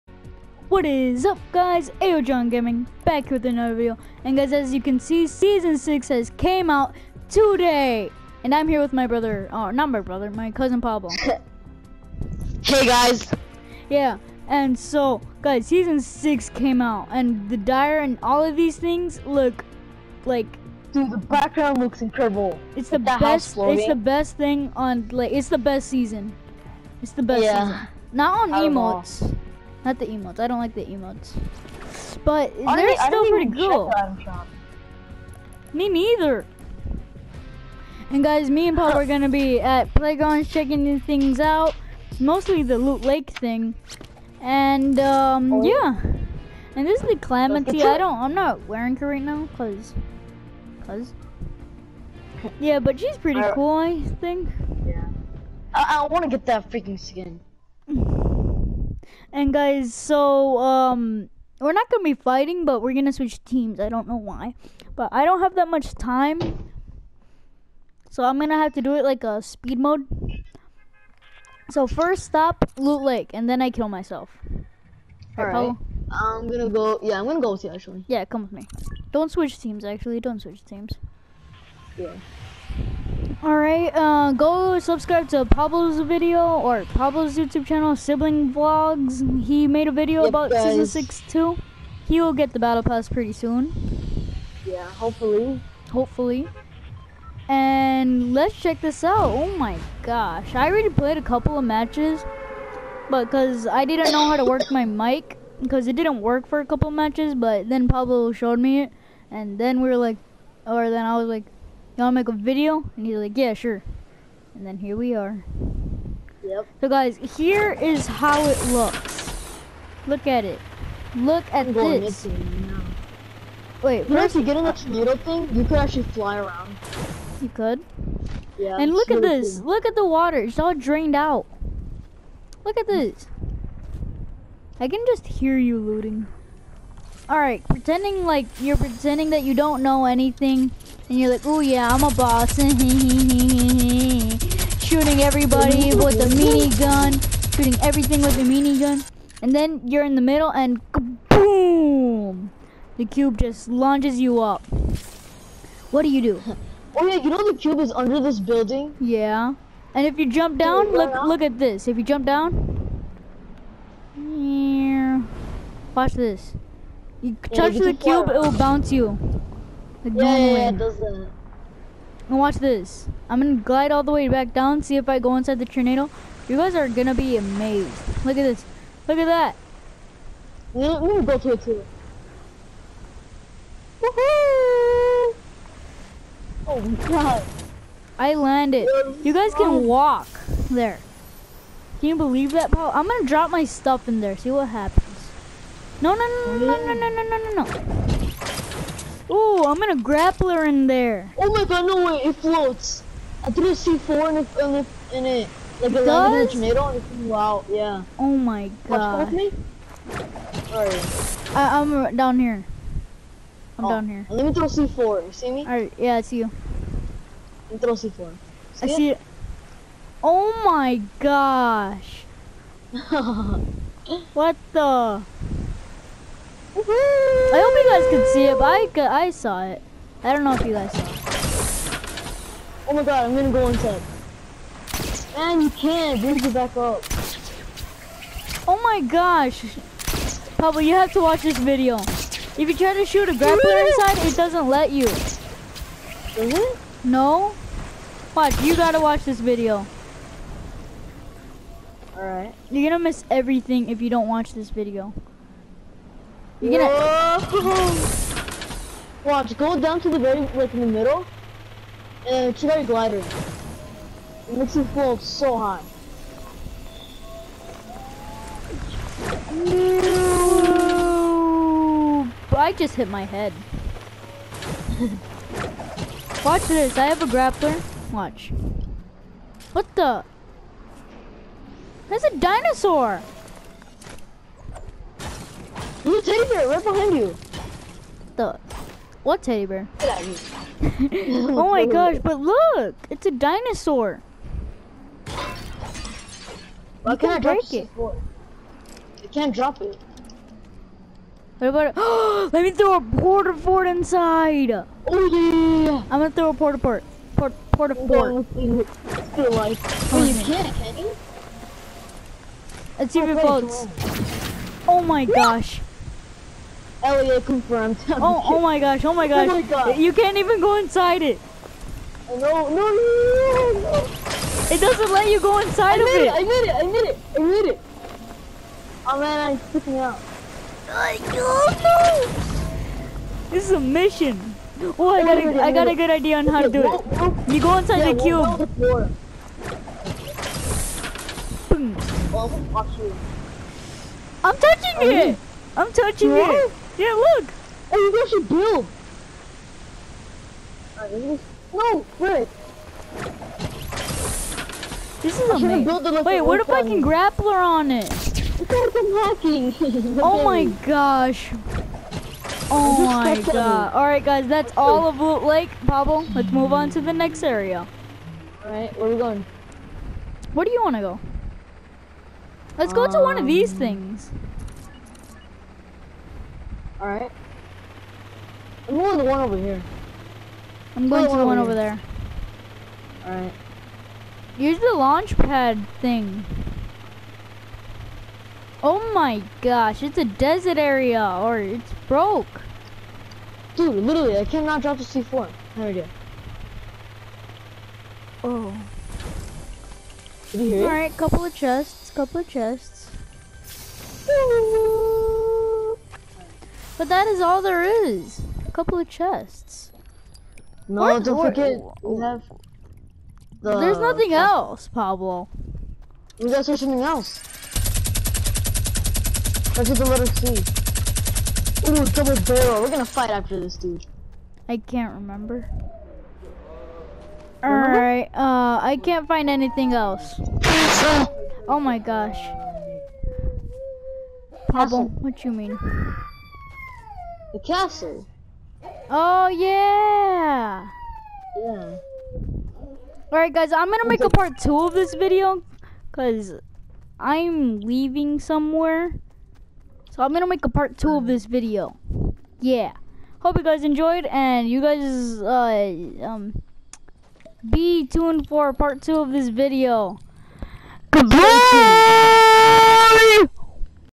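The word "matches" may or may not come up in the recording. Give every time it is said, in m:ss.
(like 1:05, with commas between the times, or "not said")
1:41, 1:46.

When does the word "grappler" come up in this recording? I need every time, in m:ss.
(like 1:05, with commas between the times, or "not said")
3:19, 4:03, 4:37, 5:57.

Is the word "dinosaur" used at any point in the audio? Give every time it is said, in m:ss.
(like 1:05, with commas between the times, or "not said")
4:42, 4:53.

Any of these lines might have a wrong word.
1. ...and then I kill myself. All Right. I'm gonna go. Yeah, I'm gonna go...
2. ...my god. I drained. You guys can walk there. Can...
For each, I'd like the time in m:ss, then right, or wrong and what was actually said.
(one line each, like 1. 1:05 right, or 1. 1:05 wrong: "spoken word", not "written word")
1. 1:13 right
2. 3:06 wrong: "landed", not "drained".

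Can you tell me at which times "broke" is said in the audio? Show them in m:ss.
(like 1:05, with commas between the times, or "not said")
6:32.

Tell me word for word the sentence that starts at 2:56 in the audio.
You guys are gonna be amazed.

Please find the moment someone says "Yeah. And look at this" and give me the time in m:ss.
2:08.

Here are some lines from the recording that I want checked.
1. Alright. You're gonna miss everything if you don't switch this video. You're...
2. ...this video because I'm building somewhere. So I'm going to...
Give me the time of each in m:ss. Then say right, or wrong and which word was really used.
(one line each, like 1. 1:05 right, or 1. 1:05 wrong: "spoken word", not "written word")
1. 4:12 wrong: "watch", not "switch"
2. 7:24 wrong: "leaving", not "building".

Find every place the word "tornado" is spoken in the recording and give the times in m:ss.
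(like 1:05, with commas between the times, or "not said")
2:04, 2:55.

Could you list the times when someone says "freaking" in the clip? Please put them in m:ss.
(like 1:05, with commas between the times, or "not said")
0:56, 5:29.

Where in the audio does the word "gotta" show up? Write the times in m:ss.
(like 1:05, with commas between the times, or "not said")
4:08, 6:56.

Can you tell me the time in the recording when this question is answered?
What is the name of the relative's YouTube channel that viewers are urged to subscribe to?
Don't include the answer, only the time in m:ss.
1:27.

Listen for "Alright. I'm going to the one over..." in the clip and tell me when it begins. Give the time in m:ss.
6:17.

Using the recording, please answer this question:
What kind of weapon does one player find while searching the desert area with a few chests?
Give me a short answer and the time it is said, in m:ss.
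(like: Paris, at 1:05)
double barrel, at 7:02.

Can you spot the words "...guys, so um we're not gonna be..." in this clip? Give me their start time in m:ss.
0:59.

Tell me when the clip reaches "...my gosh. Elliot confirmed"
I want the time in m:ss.
5:15.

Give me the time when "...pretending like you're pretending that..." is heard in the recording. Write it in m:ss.
2:17.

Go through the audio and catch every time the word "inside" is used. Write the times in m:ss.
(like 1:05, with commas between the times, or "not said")
2:55, 3:53, 4:03, 5:03, 5:20, 5:25, 5:37.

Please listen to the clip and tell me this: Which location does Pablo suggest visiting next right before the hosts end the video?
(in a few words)
The castle.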